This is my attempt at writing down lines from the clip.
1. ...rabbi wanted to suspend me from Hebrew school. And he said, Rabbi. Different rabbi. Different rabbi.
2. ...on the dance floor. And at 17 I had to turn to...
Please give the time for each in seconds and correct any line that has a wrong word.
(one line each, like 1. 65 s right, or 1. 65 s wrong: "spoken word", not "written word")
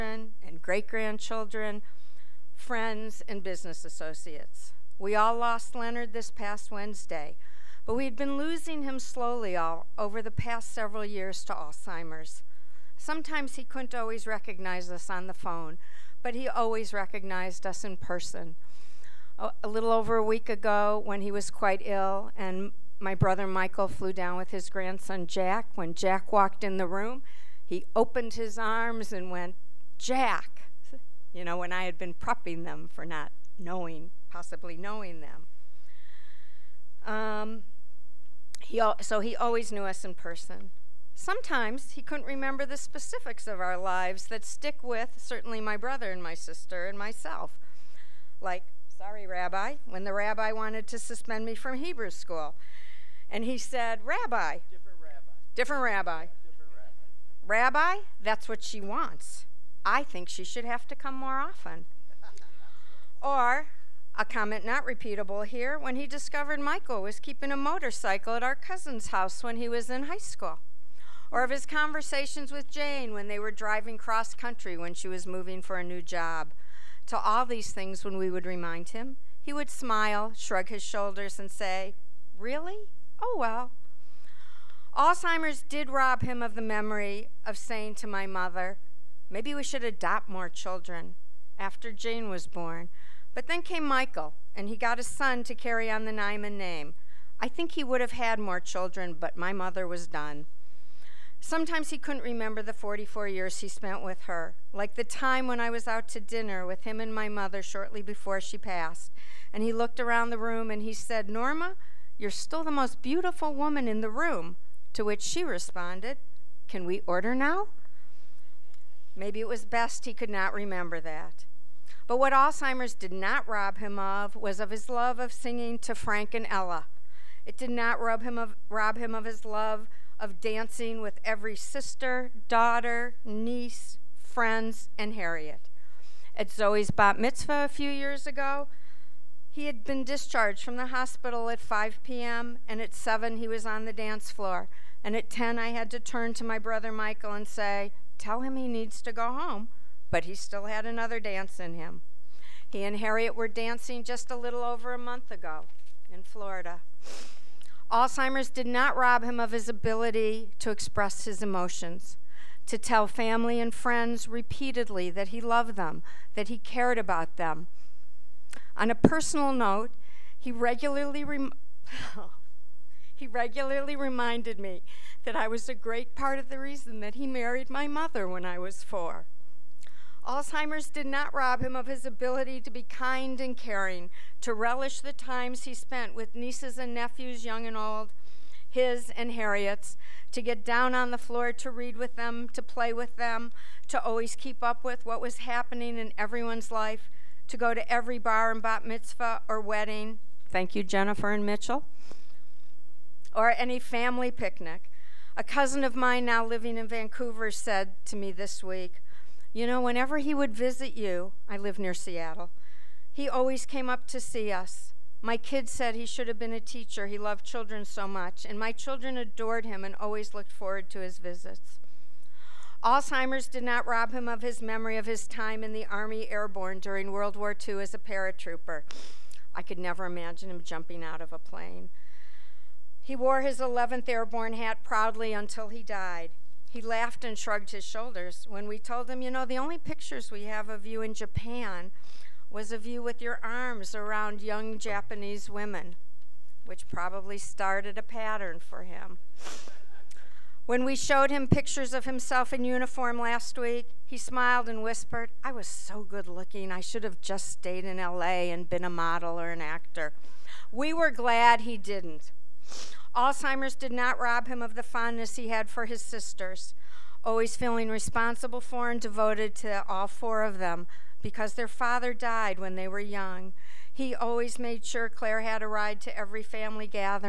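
1. 50 s right
2. 143 s wrong: "10", not "17".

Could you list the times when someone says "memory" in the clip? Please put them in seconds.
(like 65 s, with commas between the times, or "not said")
86 s, 224 s.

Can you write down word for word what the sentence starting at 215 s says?
My kids said he should have been a teacher.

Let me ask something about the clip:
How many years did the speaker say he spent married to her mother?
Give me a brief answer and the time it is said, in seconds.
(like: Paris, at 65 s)
44, at 102 s.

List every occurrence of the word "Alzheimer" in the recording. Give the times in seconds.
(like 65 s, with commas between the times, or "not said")
11 s, 84 s, 122 s, 157 s, 180 s, 222 s, 263 s.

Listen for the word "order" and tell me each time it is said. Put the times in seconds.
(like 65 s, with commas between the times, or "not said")
117 s.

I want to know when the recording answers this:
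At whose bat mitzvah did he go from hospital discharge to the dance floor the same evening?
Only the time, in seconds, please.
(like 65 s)
136 s.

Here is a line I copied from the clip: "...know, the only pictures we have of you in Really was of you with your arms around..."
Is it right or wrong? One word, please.
wrong.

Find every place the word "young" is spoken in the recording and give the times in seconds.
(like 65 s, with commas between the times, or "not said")
187 s, 244 s, 272 s.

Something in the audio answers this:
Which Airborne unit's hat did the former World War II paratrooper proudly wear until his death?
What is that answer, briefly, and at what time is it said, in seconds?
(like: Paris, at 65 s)
11th Airborne, at 233 s.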